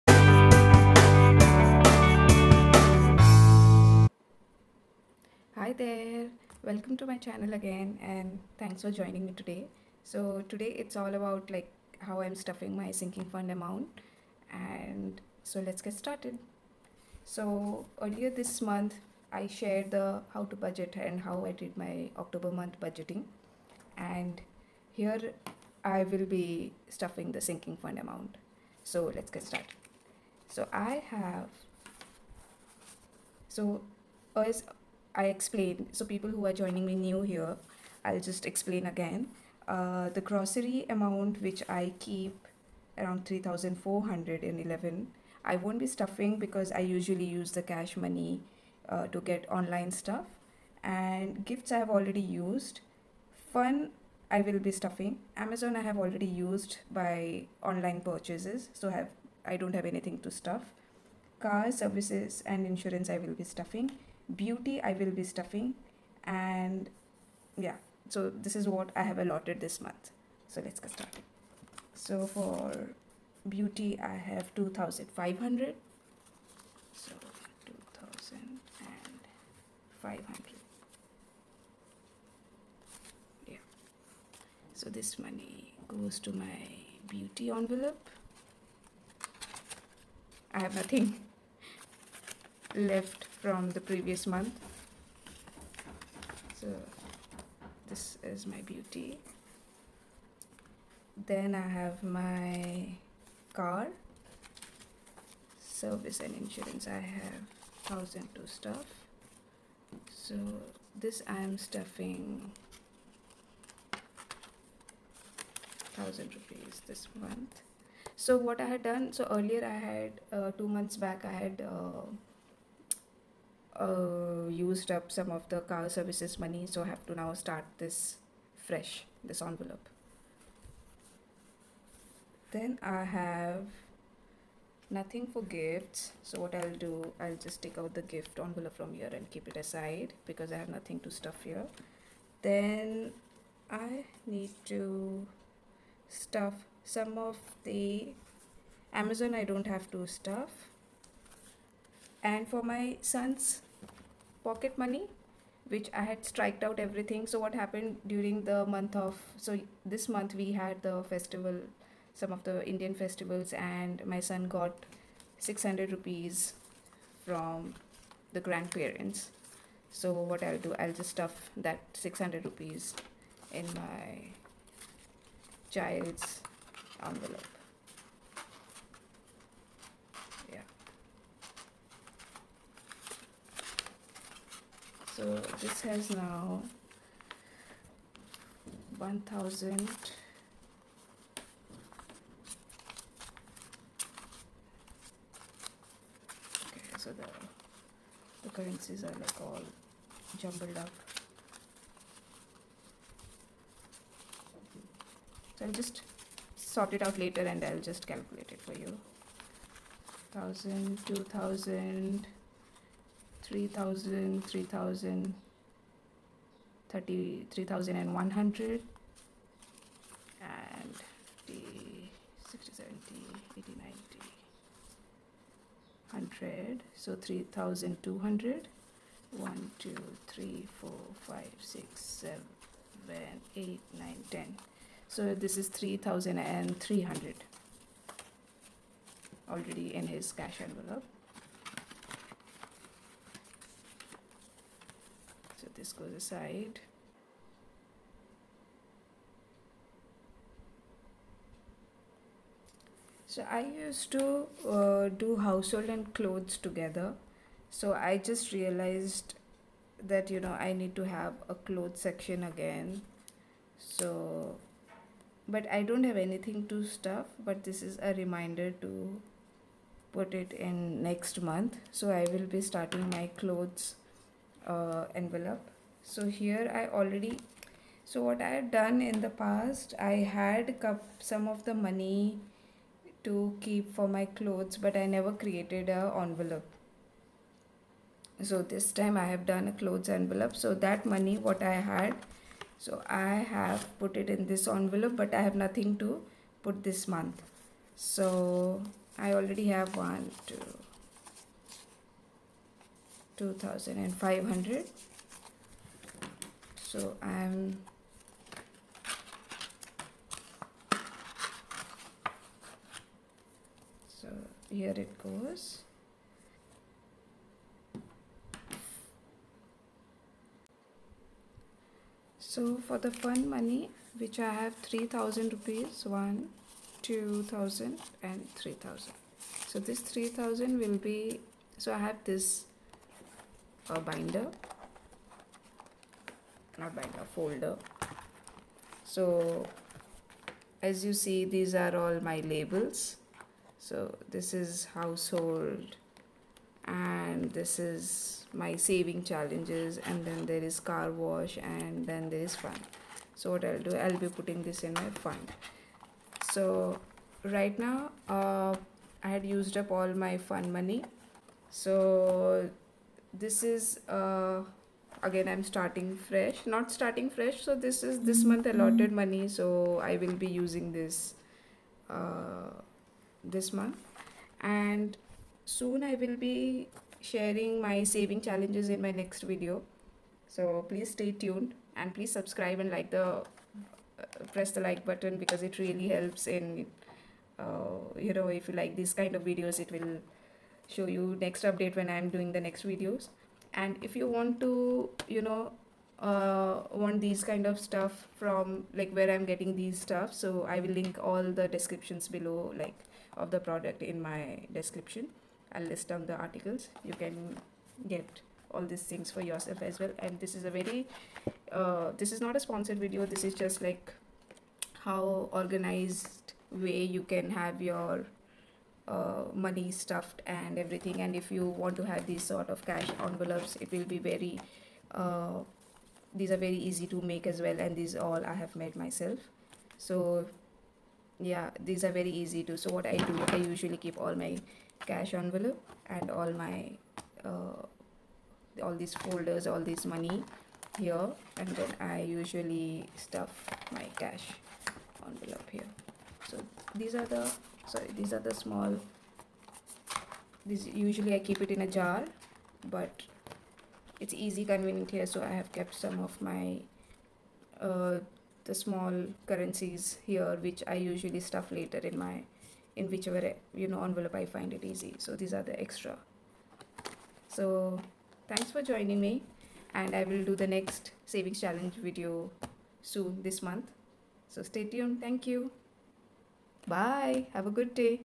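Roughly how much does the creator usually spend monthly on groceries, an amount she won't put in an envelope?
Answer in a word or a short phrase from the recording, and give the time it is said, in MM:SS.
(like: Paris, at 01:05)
3,411, at 00:43.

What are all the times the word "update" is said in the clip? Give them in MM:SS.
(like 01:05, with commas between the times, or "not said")
06:31.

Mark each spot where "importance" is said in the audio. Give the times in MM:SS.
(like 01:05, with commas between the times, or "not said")
not said.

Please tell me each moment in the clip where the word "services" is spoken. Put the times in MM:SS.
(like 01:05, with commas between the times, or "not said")
01:01, 01:45, 02:05.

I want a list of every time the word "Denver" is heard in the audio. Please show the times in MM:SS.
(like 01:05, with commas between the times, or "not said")
not said.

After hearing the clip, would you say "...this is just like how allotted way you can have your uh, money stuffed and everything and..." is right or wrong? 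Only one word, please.
wrong.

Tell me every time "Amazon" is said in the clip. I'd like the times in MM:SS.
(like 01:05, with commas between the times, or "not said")
00:55, 02:28.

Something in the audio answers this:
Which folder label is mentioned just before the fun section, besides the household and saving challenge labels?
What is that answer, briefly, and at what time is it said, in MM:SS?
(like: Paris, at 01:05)
car wash, at 05:50.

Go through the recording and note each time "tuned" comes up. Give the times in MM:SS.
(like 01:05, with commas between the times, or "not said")
06:21, 07:54.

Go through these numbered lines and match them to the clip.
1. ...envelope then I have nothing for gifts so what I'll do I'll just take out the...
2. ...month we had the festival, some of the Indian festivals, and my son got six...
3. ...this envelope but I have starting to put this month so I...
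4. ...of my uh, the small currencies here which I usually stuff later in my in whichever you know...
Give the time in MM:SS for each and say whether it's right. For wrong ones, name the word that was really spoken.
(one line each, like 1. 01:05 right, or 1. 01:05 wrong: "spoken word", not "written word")
1. 02:09 right
2. 02:40 right
3. 04:54 wrong: "nothing", not "starting"
4. 07:36 right.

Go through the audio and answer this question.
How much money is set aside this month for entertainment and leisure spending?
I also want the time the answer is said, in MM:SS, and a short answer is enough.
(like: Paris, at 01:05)
3000 rupees, at 05:24.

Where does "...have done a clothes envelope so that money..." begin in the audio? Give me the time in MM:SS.
04:49.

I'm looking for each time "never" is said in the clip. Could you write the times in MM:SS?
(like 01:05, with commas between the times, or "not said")
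04:45.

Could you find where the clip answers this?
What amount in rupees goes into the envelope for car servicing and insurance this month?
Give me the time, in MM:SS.
01:55.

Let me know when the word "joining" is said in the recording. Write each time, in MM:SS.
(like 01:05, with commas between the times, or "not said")
00:08, 00:36, 07:48.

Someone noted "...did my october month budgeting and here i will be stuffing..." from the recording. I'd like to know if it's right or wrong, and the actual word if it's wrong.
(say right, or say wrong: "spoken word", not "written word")
right.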